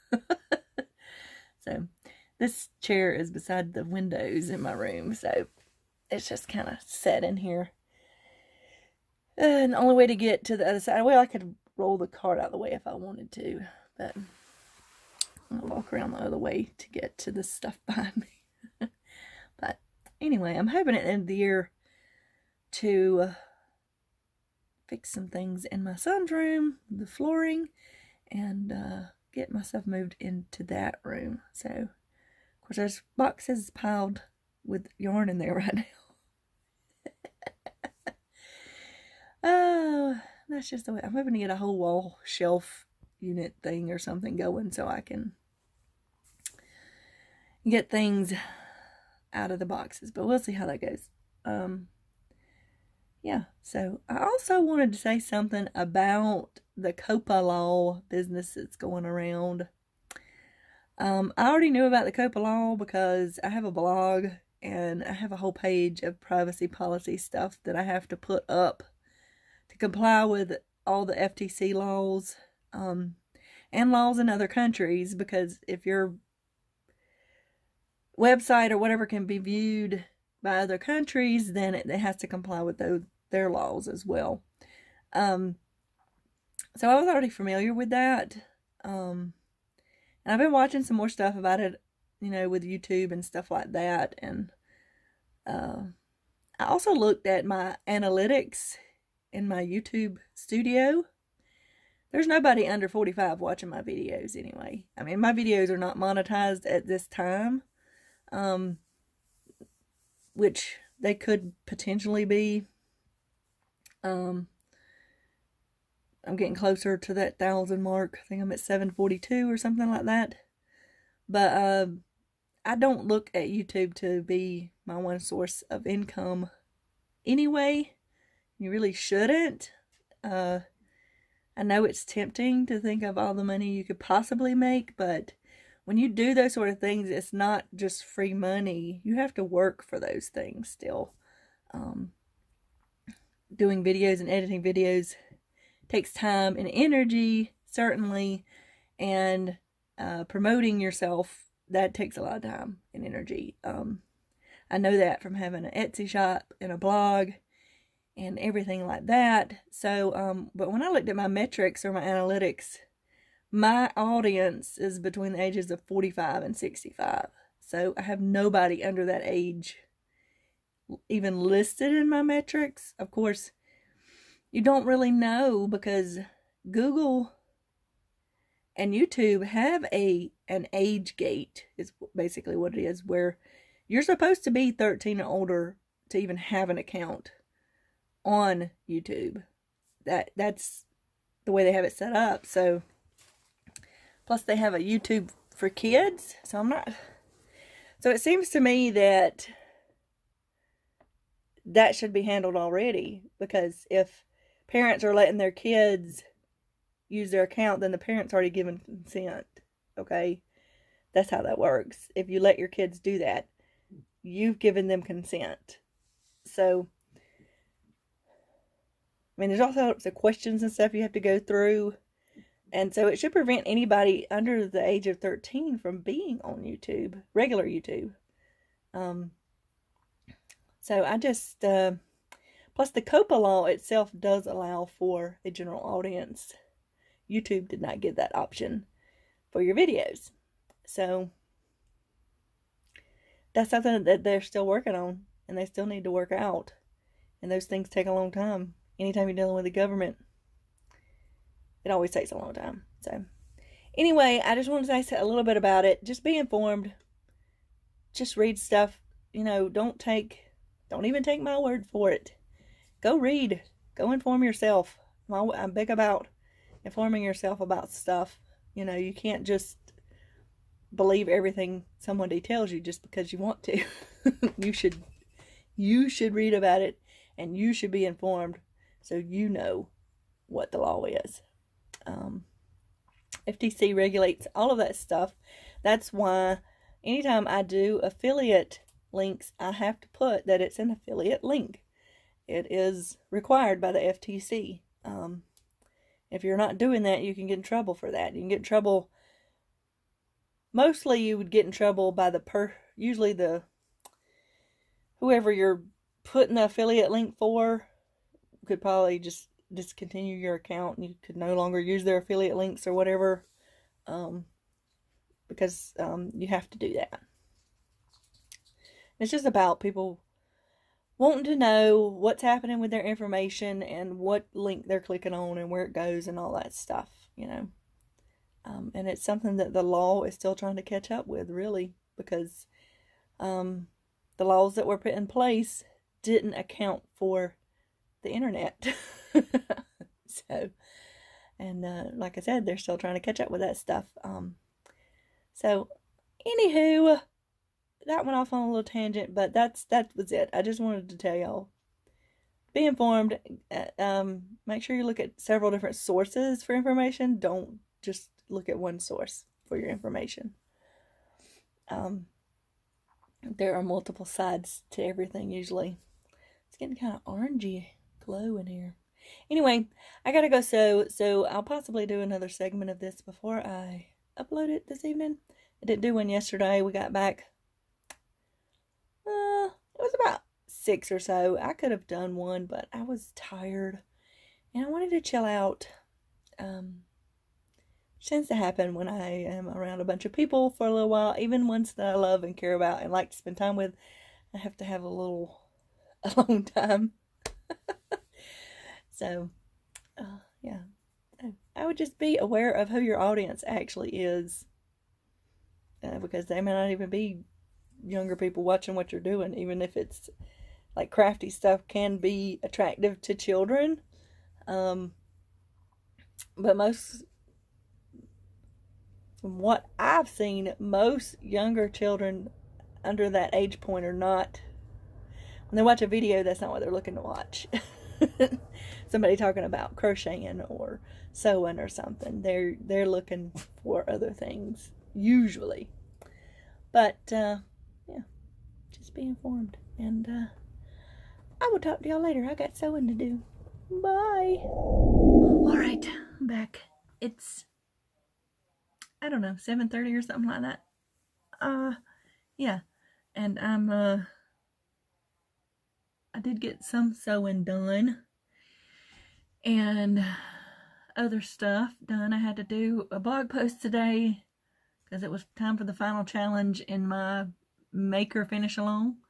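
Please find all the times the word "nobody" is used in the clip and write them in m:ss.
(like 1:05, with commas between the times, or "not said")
1:42, 2:48.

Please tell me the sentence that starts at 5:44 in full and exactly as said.
Um, so, anywho, that went off on a little tangent, but that's that was it.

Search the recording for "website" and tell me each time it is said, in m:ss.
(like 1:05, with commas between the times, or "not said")
1:18.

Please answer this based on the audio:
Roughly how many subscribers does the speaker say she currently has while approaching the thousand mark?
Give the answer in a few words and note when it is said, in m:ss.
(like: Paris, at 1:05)
742, at 1:58.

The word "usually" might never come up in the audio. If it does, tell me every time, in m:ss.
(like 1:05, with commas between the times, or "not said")
5:02, 6:05, 7:15.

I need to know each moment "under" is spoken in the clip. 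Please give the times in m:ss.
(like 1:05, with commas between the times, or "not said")
1:42, 2:48, 3:44, 7:03.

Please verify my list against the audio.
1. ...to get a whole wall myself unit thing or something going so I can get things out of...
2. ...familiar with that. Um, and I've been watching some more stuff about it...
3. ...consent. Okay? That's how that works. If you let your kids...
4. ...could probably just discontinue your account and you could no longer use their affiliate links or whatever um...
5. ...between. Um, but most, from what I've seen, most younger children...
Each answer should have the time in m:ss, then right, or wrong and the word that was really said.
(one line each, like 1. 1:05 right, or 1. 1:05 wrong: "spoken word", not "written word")
1. 0:41 wrong: "shelf", not "myself"
2. 1:27 right
3. 3:28 right
4. 5:08 right
5. 6:53 wrong: "children", not "between".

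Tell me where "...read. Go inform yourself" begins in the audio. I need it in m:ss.
4:23.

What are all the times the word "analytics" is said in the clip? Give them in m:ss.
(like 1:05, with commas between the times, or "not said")
1:37, 2:42.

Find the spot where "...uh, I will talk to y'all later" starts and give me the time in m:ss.
7:20.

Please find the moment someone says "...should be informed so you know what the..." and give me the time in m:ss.
4:37.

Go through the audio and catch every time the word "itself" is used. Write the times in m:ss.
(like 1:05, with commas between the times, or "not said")
3:53.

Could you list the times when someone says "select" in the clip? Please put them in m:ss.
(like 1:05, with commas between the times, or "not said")
not said.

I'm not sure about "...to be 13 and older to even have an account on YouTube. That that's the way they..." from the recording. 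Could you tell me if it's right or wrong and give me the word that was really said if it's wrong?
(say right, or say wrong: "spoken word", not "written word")
right.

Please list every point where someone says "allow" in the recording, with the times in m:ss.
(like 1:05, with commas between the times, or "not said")
3:54.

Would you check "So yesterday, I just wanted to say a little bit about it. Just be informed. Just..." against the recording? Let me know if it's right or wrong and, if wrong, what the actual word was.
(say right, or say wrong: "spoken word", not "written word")
wrong: "anyway", not "yesterday".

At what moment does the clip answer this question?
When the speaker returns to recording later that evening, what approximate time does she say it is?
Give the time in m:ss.
7:29.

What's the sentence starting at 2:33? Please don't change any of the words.
Um, I know that from having an Etsy shop and a blog and everything like that.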